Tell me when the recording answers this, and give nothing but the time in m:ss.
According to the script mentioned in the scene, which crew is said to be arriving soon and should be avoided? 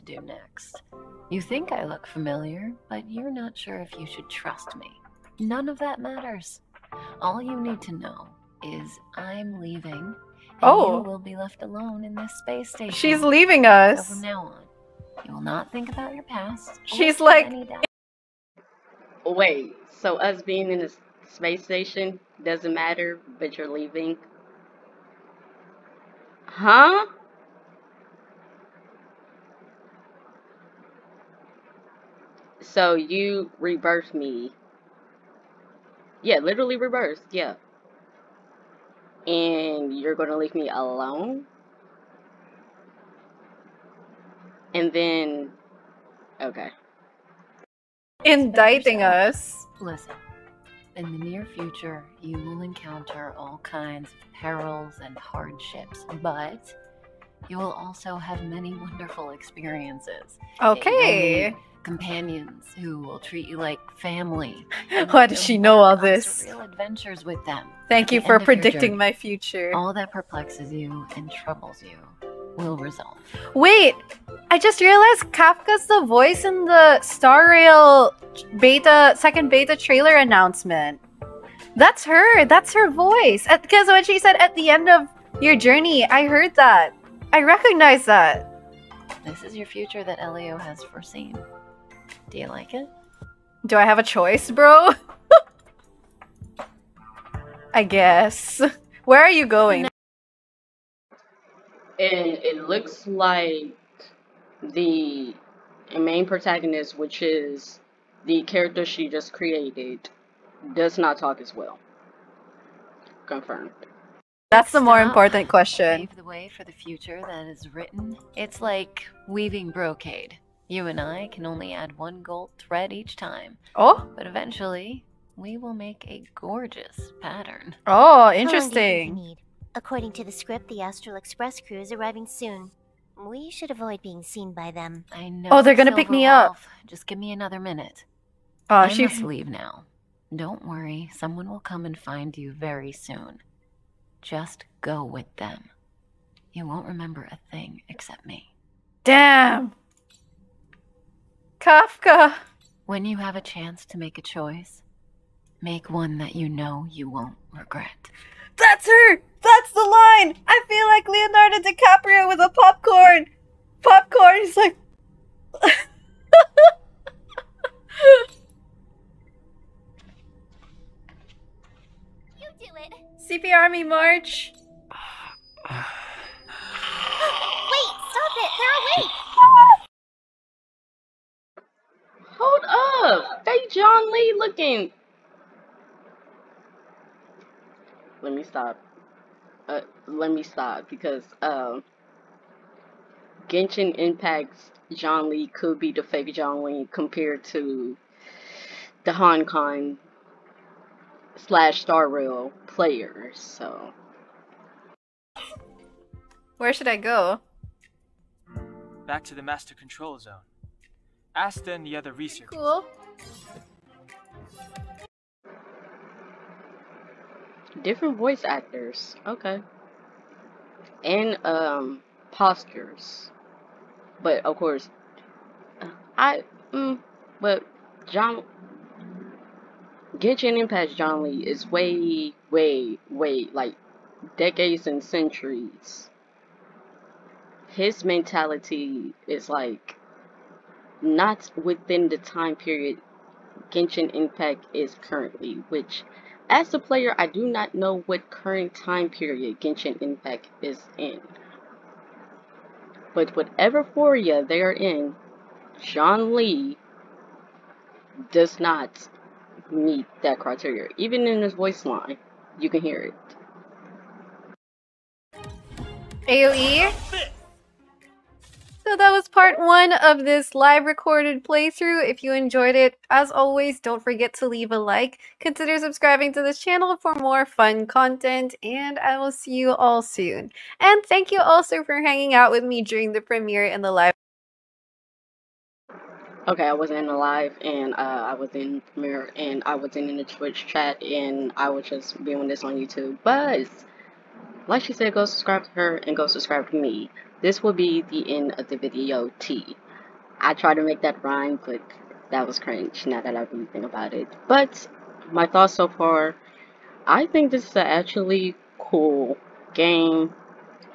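2:10.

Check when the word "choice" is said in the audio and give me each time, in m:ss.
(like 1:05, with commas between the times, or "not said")
1:34, 2:34.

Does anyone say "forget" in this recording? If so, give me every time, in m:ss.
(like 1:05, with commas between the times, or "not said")
4:34.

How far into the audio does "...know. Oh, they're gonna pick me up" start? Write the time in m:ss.
2:15.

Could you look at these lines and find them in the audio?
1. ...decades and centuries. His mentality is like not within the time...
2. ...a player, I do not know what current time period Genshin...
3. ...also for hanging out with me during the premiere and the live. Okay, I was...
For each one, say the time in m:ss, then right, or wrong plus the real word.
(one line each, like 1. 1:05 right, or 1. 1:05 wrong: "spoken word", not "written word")
1. 3:54 right
2. 4:06 right
3. 4:41 right.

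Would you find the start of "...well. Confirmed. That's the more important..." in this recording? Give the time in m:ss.
1:51.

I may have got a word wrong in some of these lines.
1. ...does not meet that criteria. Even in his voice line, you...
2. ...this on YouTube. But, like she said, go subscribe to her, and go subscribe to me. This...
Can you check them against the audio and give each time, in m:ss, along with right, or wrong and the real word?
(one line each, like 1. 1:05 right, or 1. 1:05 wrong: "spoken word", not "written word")
1. 4:18 right
2. 4:52 right.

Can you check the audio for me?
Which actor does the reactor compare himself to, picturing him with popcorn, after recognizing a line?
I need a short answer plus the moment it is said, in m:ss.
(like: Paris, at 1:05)
Leonardo DiCaprio, at 2:41.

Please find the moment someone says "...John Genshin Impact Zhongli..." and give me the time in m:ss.
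3:48.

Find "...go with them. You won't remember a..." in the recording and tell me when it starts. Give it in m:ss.
2:24.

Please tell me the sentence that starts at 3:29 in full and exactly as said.
Back to the master control zone.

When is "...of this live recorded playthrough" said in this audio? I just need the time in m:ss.
4:29.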